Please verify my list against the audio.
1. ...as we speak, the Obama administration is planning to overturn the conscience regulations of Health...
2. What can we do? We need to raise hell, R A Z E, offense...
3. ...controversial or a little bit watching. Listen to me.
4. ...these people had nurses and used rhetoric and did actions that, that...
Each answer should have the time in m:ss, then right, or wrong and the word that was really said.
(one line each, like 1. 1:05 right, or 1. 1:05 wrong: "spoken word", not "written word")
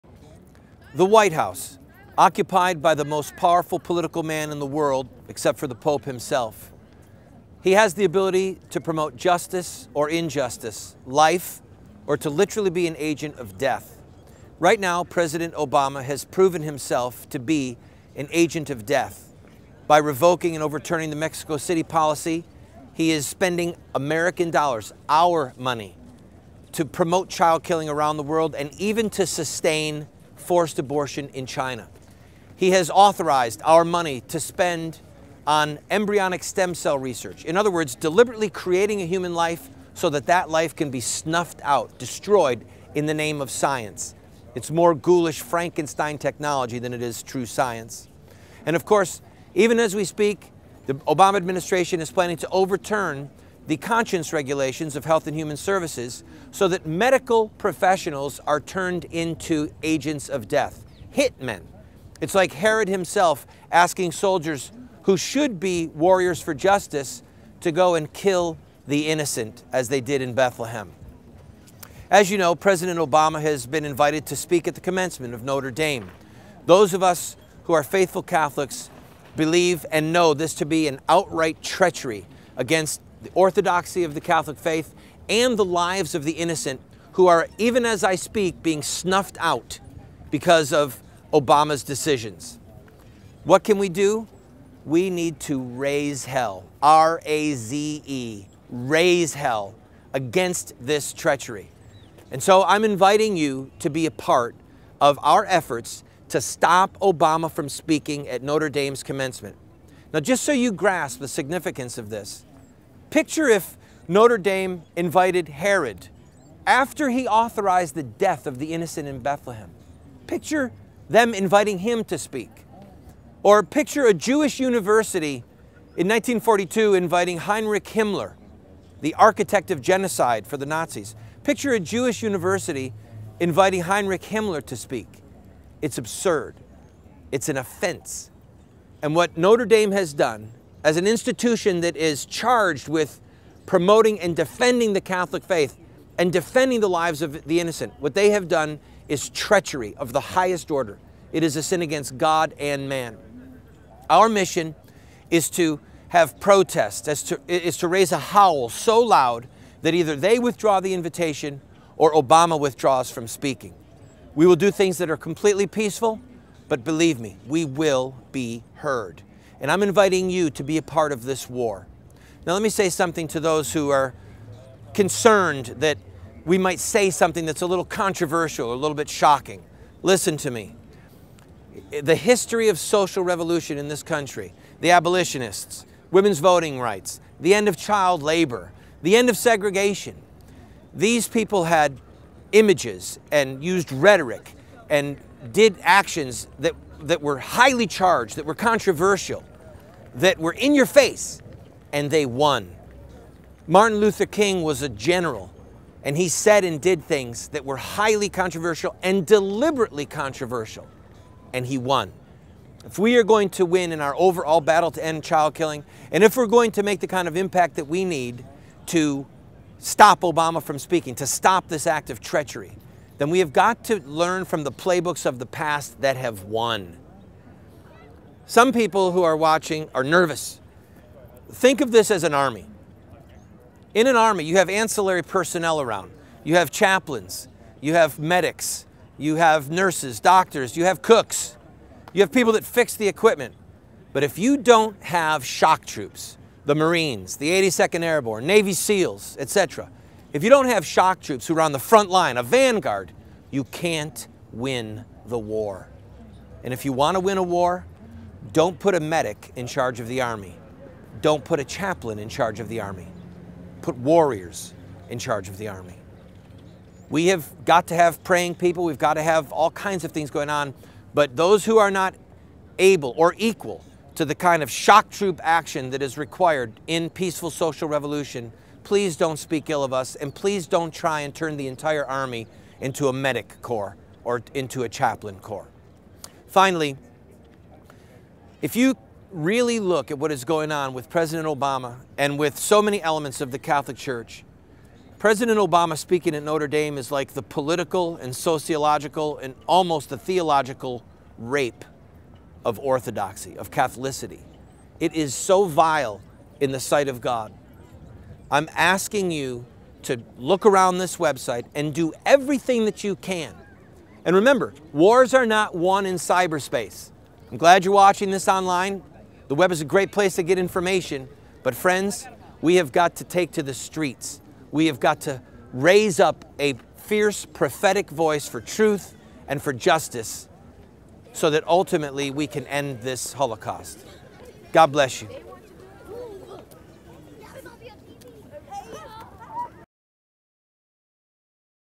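1. 0:49 right
2. 1:33 wrong: "raise", not "offense"
3. 2:57 wrong: "shocking", not "watching"
4. 3:10 wrong: "images", not "nurses".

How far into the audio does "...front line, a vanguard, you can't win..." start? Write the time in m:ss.
4:11.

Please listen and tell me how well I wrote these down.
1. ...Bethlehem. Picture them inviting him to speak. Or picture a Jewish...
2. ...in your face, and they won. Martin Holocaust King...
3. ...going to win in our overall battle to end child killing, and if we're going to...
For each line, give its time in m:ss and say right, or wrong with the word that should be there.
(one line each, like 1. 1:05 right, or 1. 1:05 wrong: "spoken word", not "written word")
1. 1:59 right
2. 3:20 wrong: "Luther", not "Holocaust"
3. 3:33 right.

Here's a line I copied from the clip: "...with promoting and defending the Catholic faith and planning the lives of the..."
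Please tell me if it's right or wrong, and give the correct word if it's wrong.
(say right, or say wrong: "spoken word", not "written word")
wrong: "defending", not "planning".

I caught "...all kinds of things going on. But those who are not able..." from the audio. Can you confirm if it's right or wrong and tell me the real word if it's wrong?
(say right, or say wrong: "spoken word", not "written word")
right.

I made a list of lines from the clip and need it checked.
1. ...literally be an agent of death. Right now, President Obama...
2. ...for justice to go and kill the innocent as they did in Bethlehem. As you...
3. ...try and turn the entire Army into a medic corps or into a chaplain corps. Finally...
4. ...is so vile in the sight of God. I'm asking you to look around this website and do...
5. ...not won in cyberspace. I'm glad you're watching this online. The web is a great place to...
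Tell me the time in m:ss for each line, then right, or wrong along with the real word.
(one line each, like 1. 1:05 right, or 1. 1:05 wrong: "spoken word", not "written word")
1. 0:12 right
2. 1:06 right
3. 4:40 right
4. 5:05 right
5. 5:15 right.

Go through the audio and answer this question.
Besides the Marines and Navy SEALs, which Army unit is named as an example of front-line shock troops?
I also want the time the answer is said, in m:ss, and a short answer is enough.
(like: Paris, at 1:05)
82nd Airborne, at 4:07.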